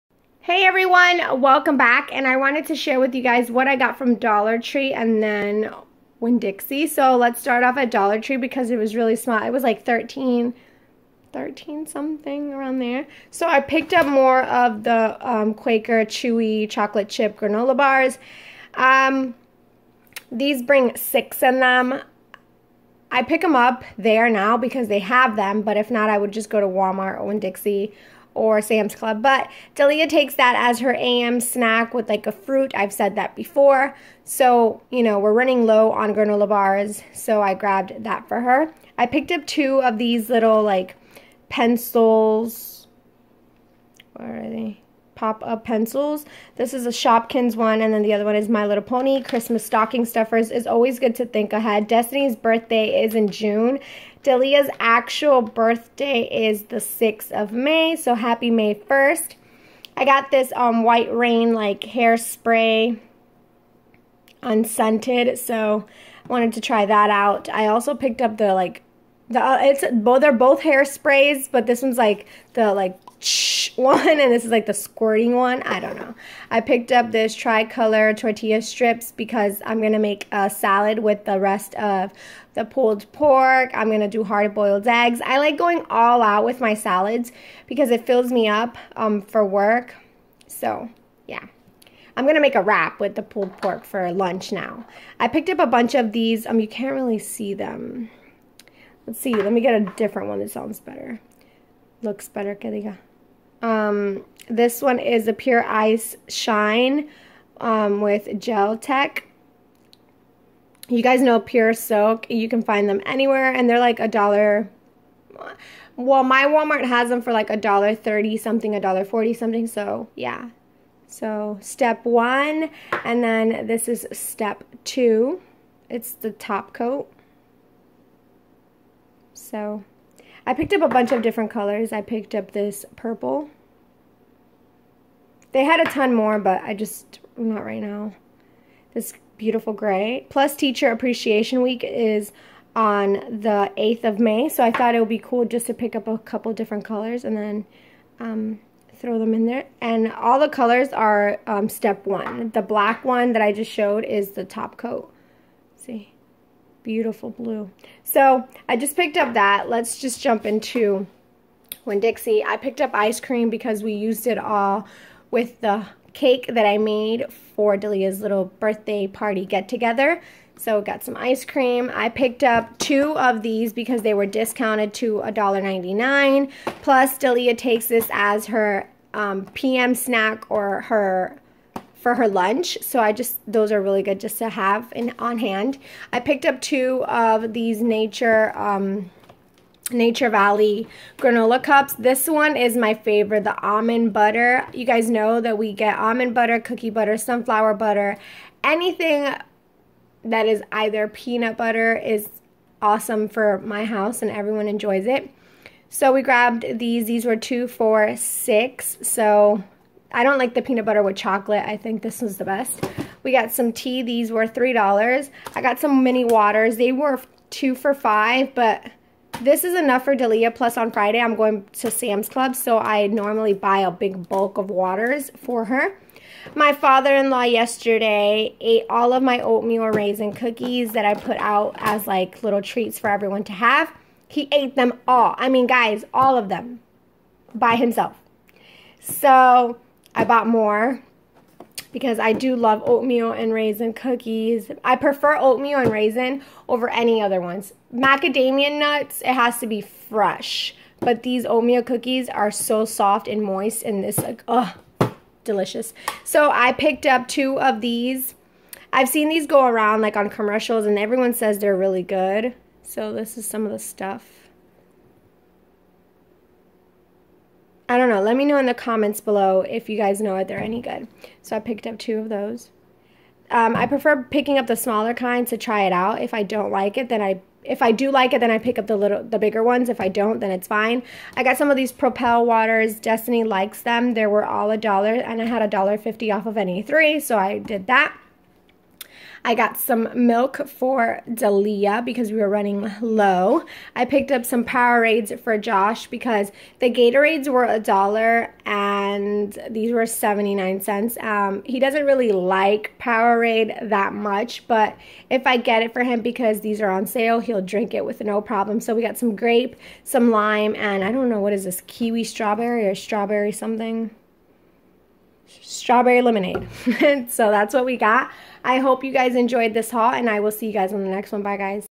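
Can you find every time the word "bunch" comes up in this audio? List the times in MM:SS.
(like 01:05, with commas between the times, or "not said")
01:35, 02:10.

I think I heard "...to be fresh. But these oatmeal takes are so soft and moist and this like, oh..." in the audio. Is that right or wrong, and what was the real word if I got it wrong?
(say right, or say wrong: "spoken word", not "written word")
wrong: "cookies", not "takes".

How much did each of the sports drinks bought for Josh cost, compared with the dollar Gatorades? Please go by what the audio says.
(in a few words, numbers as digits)
79 cents.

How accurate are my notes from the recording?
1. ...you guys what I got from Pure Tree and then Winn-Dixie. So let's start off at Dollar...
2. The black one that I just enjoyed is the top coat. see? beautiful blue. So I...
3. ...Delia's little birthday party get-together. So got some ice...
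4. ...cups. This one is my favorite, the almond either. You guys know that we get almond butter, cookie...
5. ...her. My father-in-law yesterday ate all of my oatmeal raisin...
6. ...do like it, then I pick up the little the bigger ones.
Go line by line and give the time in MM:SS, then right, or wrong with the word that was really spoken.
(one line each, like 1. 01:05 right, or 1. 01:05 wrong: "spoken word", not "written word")
1. 00:03 wrong: "Dollar", not "Pure"
2. 02:32 wrong: "showed", not "enjoyed"
3. 02:47 right
4. 03:11 wrong: "butter", not "either"
5. 03:45 right
6. 04:37 right.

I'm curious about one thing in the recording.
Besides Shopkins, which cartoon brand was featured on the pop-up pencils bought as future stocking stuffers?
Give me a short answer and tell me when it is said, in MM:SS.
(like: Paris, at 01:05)
My Little Pony, at 00:48.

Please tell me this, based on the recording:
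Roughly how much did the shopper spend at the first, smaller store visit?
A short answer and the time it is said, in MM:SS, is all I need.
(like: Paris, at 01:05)
13, at 00:11.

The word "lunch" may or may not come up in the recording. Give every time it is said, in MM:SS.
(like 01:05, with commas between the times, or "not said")
01:34, 03:02.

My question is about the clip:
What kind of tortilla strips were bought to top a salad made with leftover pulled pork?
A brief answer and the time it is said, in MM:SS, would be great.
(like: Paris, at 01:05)
Tricolor, at 01:17.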